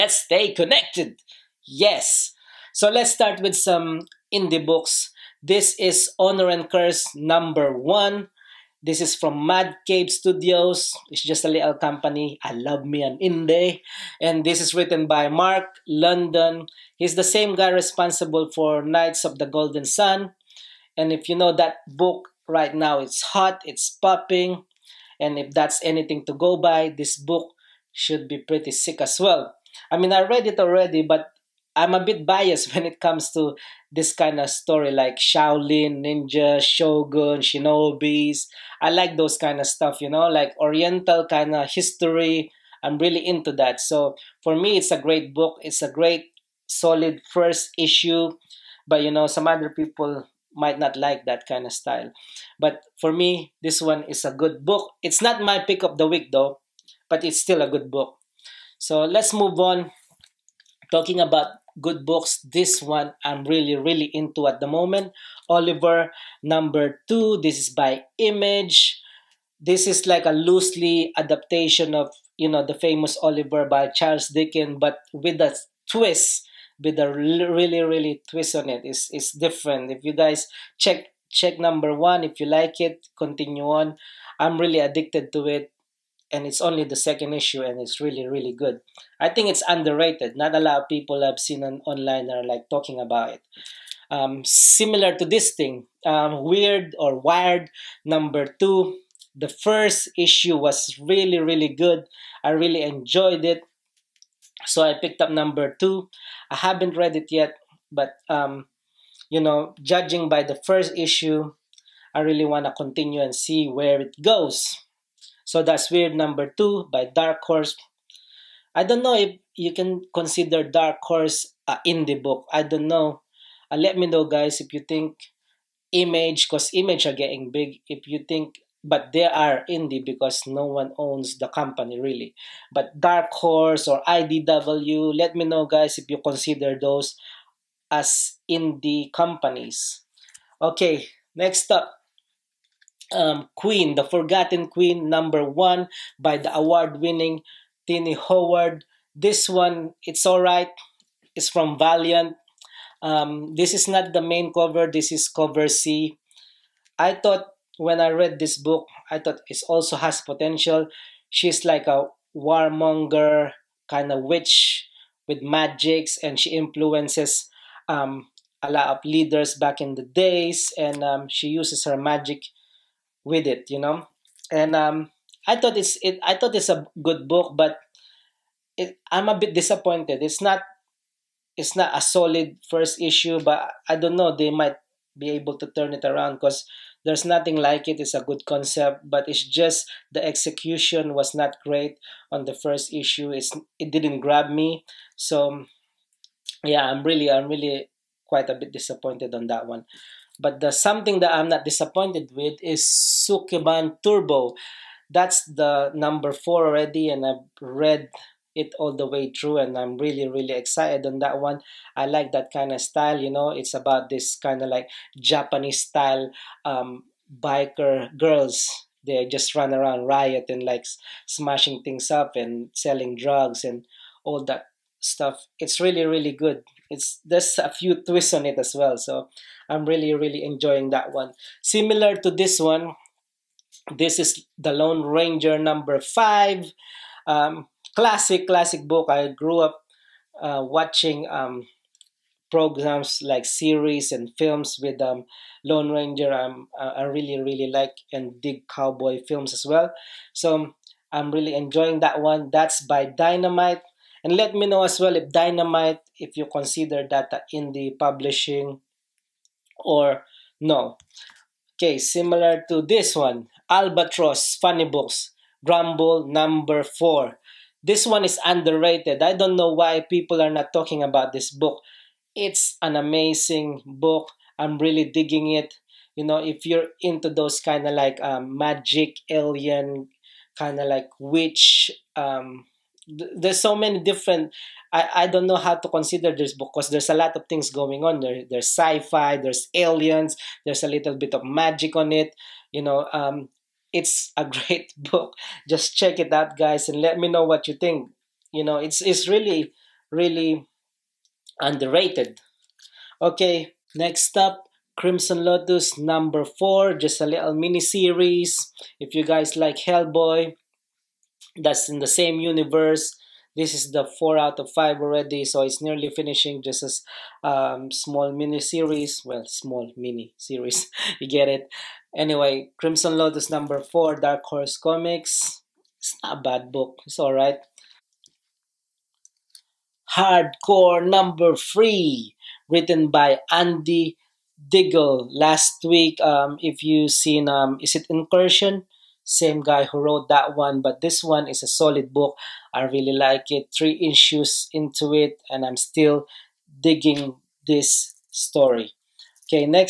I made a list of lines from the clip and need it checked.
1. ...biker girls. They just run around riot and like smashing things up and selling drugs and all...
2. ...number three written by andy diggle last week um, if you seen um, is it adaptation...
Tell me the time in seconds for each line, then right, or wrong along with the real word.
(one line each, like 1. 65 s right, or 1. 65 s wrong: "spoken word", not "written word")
1. 217 s right
2. 331 s wrong: "incursion", not "adaptation".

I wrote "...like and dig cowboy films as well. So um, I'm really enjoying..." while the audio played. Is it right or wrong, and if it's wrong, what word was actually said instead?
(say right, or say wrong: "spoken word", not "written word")
right.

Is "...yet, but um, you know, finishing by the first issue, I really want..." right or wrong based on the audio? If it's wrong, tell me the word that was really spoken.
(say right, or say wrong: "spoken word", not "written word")
wrong: "judging", not "finishing".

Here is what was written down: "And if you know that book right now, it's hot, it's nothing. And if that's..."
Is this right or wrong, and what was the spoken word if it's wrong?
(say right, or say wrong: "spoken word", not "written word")
wrong: "popping", not "nothing".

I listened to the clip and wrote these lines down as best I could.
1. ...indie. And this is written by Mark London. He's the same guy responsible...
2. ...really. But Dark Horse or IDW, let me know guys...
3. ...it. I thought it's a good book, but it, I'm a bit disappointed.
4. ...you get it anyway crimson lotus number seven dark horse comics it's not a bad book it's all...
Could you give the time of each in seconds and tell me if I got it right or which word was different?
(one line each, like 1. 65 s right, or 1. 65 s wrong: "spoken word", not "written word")
1. 13 s right
2. 131 s right
3. 176 s right
4. 321 s wrong: "four", not "seven".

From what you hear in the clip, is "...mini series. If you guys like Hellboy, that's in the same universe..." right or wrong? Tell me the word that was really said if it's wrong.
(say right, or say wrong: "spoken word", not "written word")
right.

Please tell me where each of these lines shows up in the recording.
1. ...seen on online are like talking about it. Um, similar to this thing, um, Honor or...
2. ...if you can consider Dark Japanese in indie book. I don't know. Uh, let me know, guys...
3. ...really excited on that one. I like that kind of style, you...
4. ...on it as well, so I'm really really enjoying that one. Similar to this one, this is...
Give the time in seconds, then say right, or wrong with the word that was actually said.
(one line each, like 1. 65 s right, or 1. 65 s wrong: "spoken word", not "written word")
1. 91 s wrong: "Wyrd", not "Honor"
2. 119 s wrong: "Horse", not "Japanese"
3. 210 s right
4. 228 s right.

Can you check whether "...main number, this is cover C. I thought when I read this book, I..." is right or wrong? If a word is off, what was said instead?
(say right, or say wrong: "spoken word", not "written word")
wrong: "cover", not "number".